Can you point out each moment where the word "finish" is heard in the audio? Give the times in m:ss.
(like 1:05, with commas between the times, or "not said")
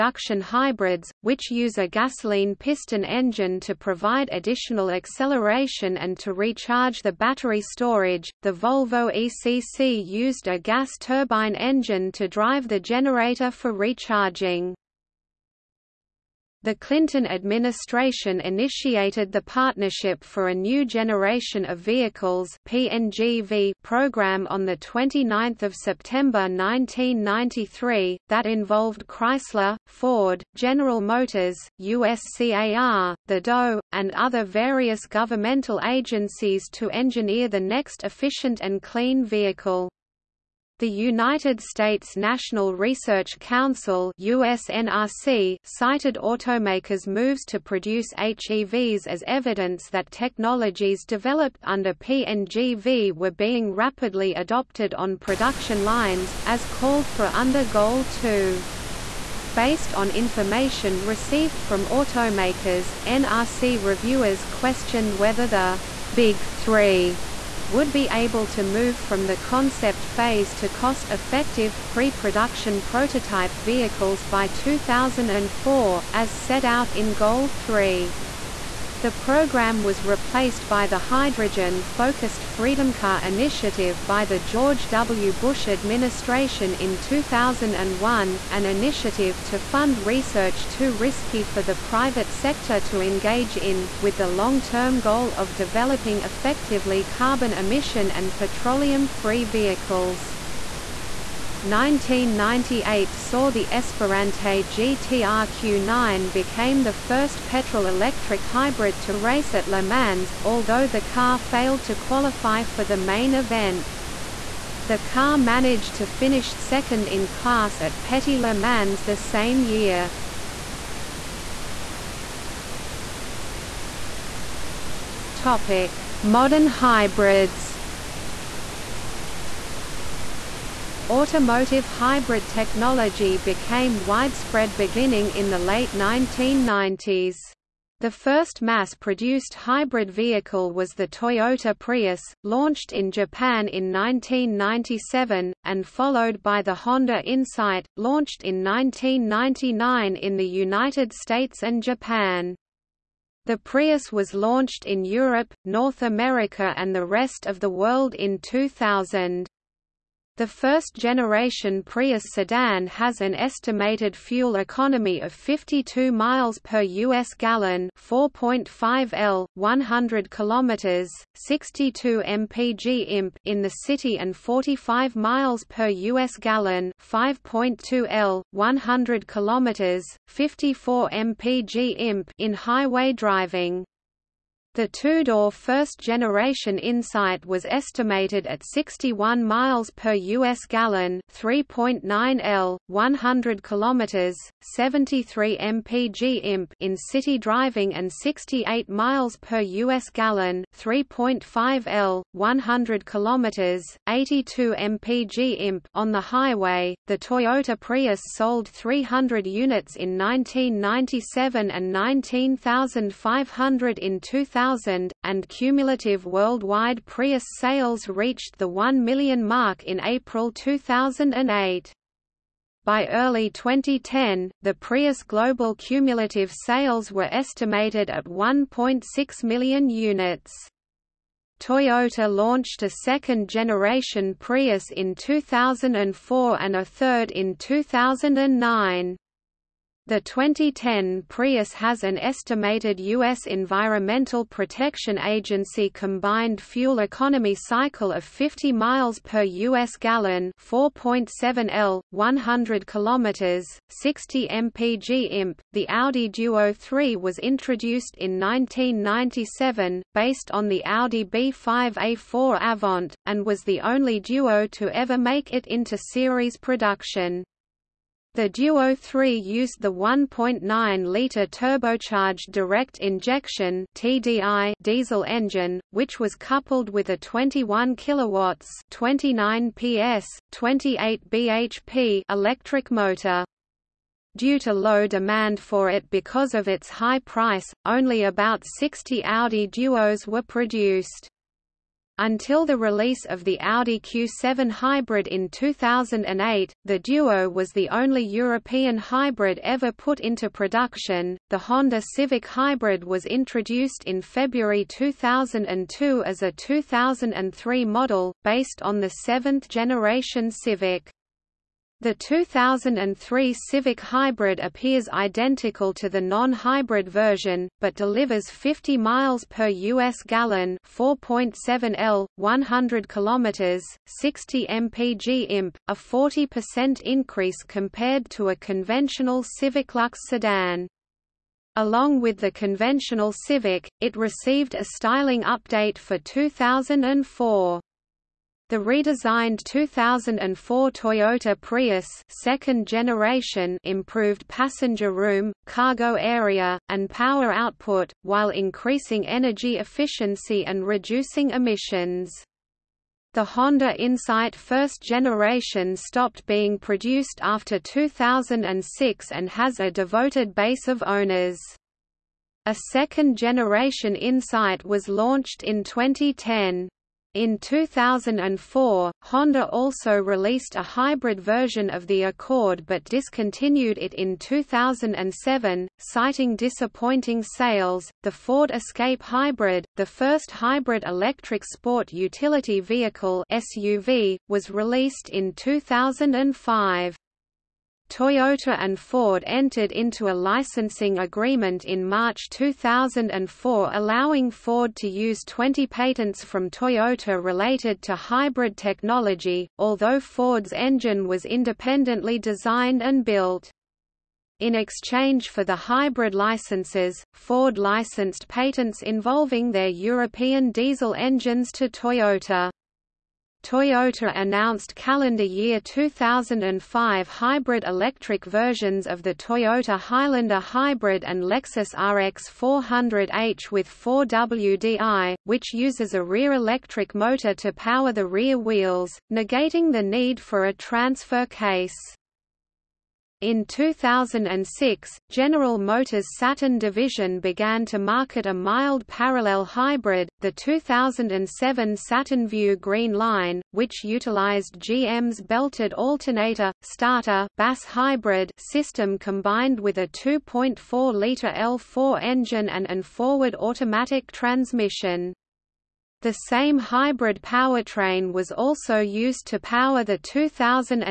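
1:56.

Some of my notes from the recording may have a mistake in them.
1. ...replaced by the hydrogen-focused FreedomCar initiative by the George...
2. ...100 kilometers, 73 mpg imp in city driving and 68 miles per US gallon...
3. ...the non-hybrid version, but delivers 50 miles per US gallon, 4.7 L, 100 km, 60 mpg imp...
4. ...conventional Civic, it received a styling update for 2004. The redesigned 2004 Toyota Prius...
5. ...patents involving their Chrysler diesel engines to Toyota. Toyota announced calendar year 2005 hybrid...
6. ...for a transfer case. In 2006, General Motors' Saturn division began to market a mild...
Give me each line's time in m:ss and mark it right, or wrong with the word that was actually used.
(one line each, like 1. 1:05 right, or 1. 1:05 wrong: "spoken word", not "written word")
1. 1:20 right
2. 3:12 right
3. 5:16 right
4. 5:32 right
5. 6:48 wrong: "European", not "Chrysler"
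6. 7:10 right.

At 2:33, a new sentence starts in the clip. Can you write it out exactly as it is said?
The Prius was launched in Europe, North America and the rest of the world in 2000.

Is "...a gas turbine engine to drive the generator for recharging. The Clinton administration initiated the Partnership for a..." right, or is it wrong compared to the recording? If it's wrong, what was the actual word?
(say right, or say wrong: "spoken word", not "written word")
right.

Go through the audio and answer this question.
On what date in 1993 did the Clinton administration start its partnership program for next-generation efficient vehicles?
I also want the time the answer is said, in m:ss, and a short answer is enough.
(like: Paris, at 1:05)
29th of September, at 0:24.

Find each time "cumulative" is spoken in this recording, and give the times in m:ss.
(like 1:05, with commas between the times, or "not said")
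3:35, 3:45.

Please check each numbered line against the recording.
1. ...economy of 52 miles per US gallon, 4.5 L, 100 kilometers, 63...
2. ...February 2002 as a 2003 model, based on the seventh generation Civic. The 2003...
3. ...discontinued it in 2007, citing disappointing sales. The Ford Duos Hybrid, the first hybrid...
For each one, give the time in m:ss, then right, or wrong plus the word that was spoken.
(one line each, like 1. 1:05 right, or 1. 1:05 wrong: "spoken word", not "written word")
1. 2:44 wrong: "62", not "63"
2. 5:04 right
3. 6:13 wrong: "Escape", not "Duos".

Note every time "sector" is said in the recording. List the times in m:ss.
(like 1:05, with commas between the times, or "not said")
1:32.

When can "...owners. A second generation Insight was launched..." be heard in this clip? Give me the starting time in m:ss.
6:01.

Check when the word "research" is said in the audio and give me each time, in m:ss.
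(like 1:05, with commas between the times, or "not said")
0:42, 1:29.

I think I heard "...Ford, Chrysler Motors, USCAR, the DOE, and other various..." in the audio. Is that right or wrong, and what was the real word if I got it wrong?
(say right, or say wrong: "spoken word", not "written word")
wrong: "General", not "Chrysler".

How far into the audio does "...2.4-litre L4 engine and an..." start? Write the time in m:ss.
7:30.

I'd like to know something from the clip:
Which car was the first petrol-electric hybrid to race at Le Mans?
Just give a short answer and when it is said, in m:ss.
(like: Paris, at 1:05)
Esperante GTR-Q9, at 1:43.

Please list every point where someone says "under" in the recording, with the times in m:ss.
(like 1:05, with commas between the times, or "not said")
0:51, 0:57.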